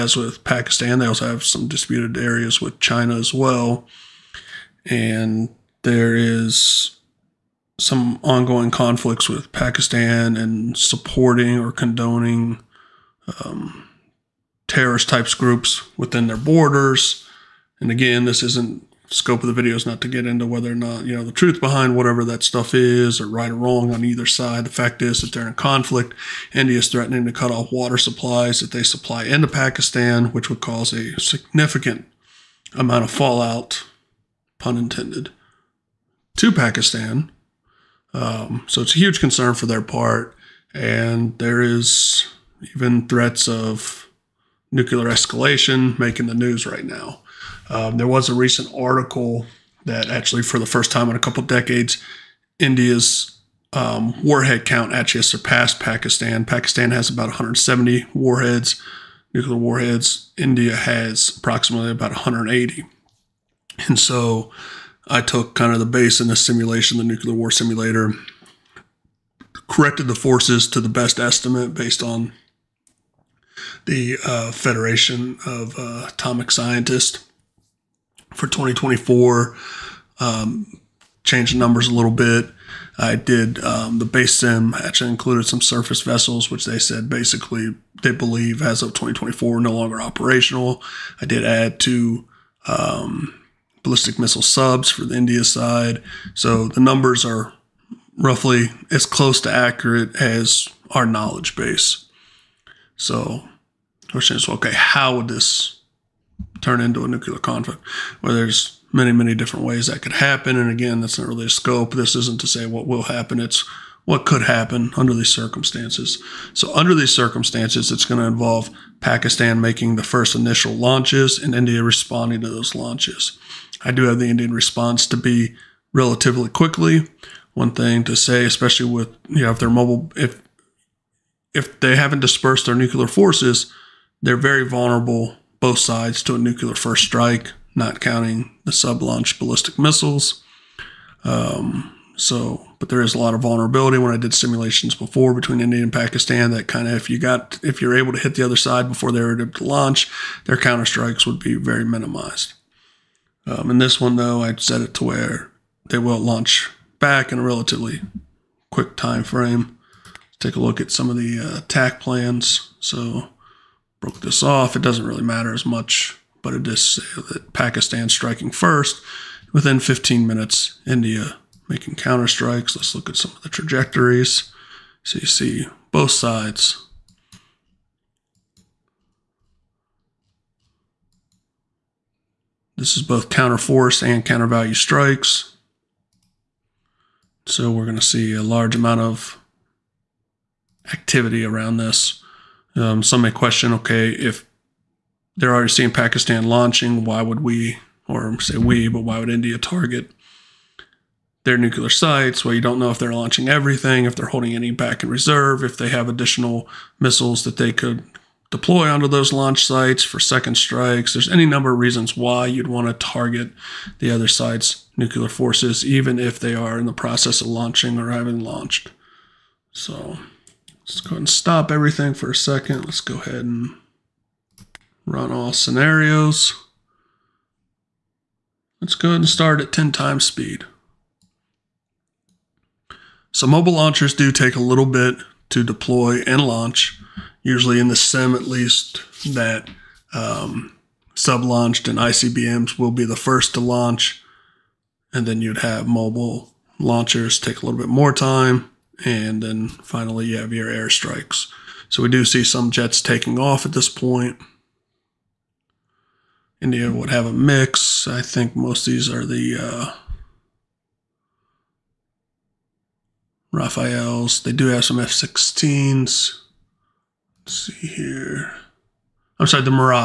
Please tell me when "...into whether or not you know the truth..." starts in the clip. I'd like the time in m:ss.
0:20.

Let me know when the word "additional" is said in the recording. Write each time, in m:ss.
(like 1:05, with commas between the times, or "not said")
3:26.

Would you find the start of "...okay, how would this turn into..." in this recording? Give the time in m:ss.
1:44.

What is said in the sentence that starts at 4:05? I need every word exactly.
And then you'd have mobile launchers take a little bit more time.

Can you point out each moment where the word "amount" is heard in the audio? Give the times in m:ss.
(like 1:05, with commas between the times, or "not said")
0:32, 3:08.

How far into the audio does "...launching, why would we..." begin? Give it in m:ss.
3:16.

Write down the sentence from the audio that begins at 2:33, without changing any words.
Um, in this one though, I set it to where they will launch back in a relatively quick time frame.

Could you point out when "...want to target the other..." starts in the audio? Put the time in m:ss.
3:32.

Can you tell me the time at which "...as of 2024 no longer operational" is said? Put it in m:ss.
1:28.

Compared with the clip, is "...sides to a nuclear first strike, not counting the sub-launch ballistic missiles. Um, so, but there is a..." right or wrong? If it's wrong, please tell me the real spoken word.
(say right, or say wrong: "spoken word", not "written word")
right.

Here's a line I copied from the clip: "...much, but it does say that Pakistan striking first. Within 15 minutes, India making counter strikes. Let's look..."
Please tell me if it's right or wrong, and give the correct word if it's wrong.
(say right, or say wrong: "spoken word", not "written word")
right.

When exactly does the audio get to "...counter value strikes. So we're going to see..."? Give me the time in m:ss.
3:04.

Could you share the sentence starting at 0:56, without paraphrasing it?
Pakistan has about 170 warheads, nuclear warheads.